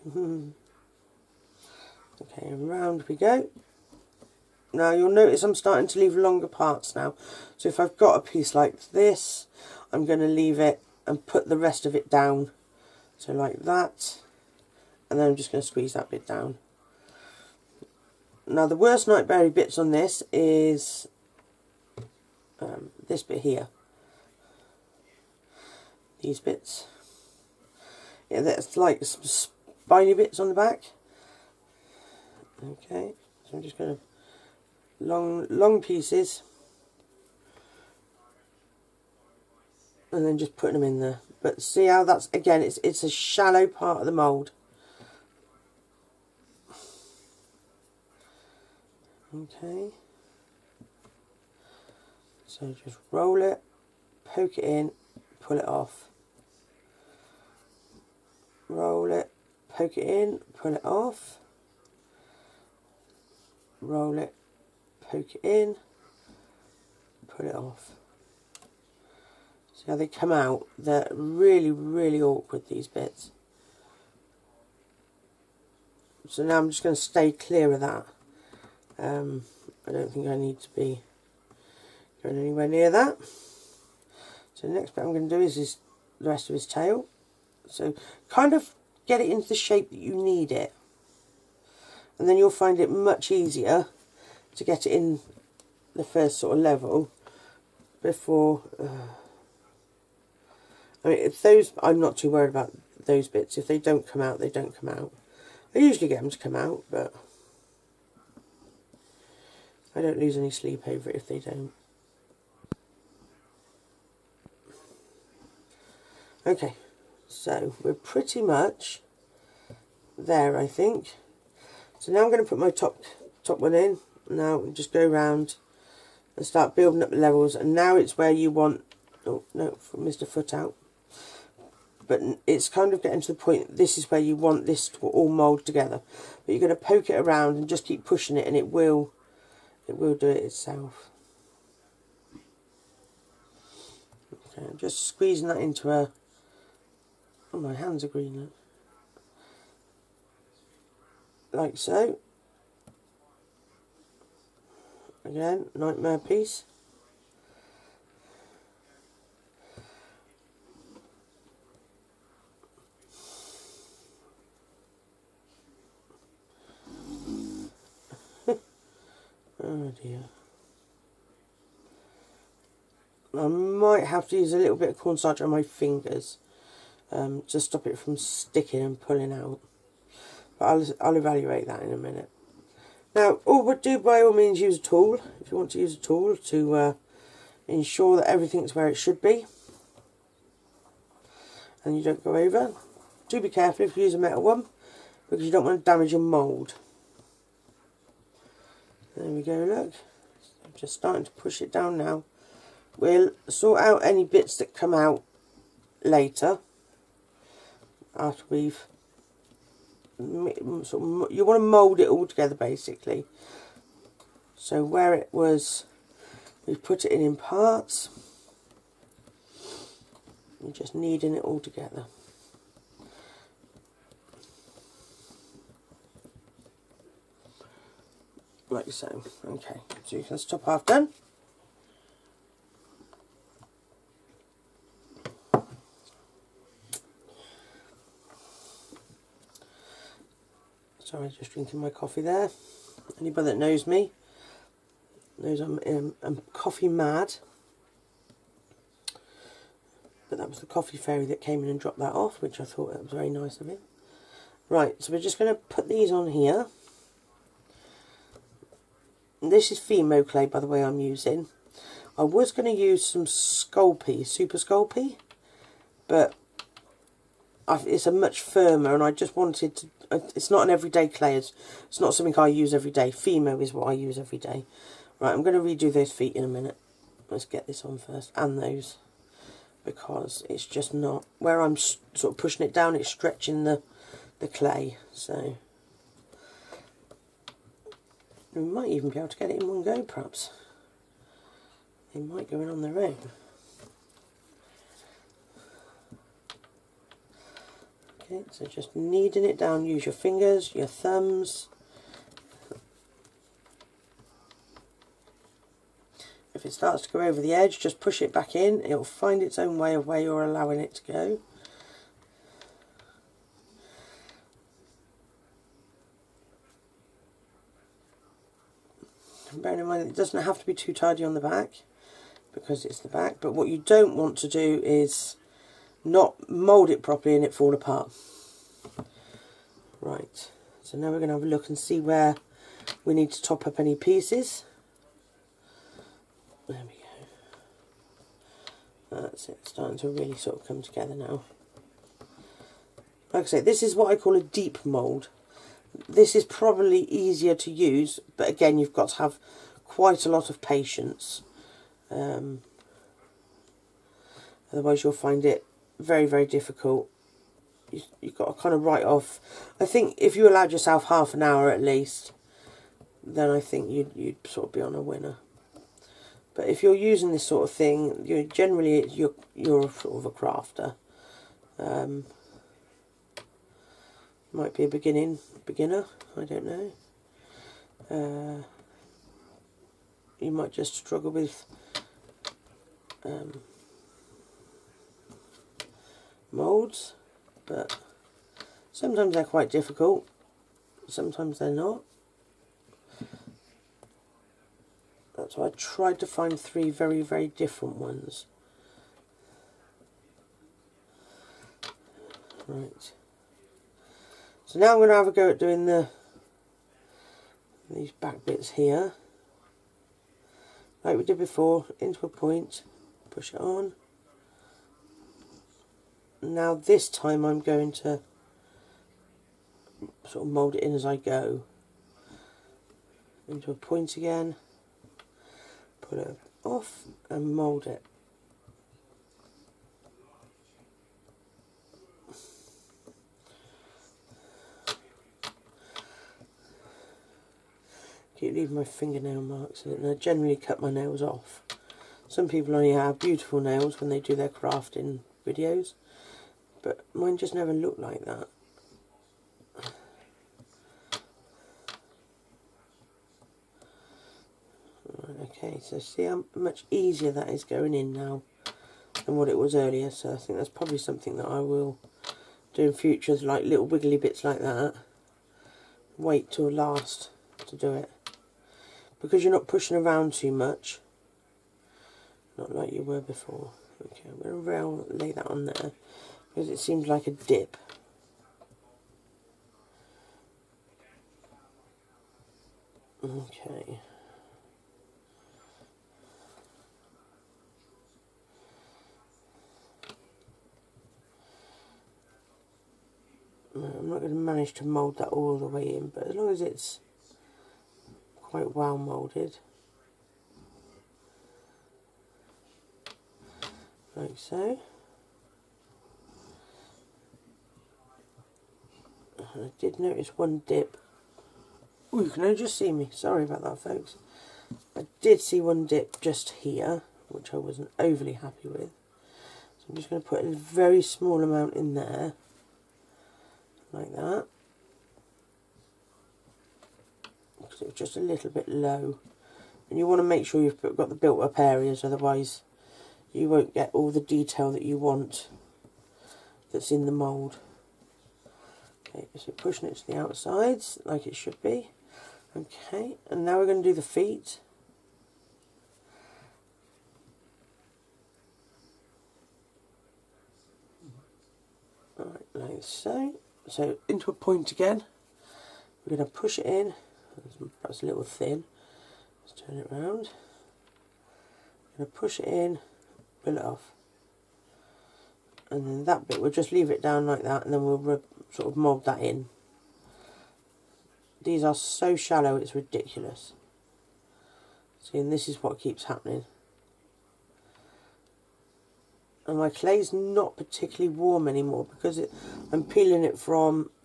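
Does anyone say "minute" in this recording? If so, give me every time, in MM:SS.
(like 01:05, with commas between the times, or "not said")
03:01, 04:36.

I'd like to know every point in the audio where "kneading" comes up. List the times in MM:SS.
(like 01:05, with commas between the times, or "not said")
03:40, 04:58.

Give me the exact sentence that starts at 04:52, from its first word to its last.
They might go in on their own.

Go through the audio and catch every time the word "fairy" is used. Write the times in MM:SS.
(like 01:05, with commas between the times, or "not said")
04:10.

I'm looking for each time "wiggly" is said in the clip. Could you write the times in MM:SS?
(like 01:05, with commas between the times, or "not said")
07:43.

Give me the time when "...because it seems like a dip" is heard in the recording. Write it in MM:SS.
07:56.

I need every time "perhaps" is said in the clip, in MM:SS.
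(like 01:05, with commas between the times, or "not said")
04:50, 09:17.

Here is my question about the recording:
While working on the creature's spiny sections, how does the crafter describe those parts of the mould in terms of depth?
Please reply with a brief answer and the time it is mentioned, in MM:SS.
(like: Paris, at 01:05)
shallow part, at 00:43.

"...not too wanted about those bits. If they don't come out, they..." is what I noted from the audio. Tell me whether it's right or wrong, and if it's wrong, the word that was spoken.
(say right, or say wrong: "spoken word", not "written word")
wrong: "worried", not "wanted".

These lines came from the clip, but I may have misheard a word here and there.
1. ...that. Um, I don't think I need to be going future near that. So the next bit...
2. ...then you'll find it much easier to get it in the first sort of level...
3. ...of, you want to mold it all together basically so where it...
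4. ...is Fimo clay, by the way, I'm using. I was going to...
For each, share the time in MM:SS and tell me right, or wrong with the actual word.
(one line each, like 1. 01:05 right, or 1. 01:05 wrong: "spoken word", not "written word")
1. 01:17 wrong: "anywhere", not "future"
2. 01:32 right
3. 03:31 right
4. 04:19 right.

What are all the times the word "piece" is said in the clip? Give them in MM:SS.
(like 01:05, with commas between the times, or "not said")
00:08, 00:35, 02:36, 05:33.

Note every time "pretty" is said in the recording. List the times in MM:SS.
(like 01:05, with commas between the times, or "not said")
01:57.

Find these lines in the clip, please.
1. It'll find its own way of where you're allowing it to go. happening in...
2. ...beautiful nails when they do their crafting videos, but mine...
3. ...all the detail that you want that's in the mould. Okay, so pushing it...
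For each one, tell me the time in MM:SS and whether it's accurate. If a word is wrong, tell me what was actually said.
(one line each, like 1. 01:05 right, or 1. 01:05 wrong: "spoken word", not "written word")
1. 05:08 wrong: "bearing", not "happening"
2. 07:23 right
3. 08:53 right.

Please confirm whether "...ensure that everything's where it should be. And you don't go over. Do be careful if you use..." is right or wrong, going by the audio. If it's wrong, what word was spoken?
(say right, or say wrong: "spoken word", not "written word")
right.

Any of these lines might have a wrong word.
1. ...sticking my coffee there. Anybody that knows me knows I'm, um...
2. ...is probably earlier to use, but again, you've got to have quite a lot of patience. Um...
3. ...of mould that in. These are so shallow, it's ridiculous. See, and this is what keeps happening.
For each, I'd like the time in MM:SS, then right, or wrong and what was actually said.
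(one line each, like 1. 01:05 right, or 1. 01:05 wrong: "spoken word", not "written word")
1. 04:01 wrong: "drinking", not "sticking"
2. 05:46 wrong: "easier", not "earlier"
3. 09:28 right.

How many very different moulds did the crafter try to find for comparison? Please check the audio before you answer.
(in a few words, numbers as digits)
3.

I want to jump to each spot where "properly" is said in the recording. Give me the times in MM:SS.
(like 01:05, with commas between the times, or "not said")
05:27.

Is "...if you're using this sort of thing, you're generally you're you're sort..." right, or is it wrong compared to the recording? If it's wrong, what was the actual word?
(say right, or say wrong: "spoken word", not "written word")
right.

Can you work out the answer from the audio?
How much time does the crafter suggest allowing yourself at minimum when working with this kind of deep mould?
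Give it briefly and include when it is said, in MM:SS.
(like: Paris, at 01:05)
half an hour, at 06:01.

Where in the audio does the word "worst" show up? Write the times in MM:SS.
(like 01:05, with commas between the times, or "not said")
00:18.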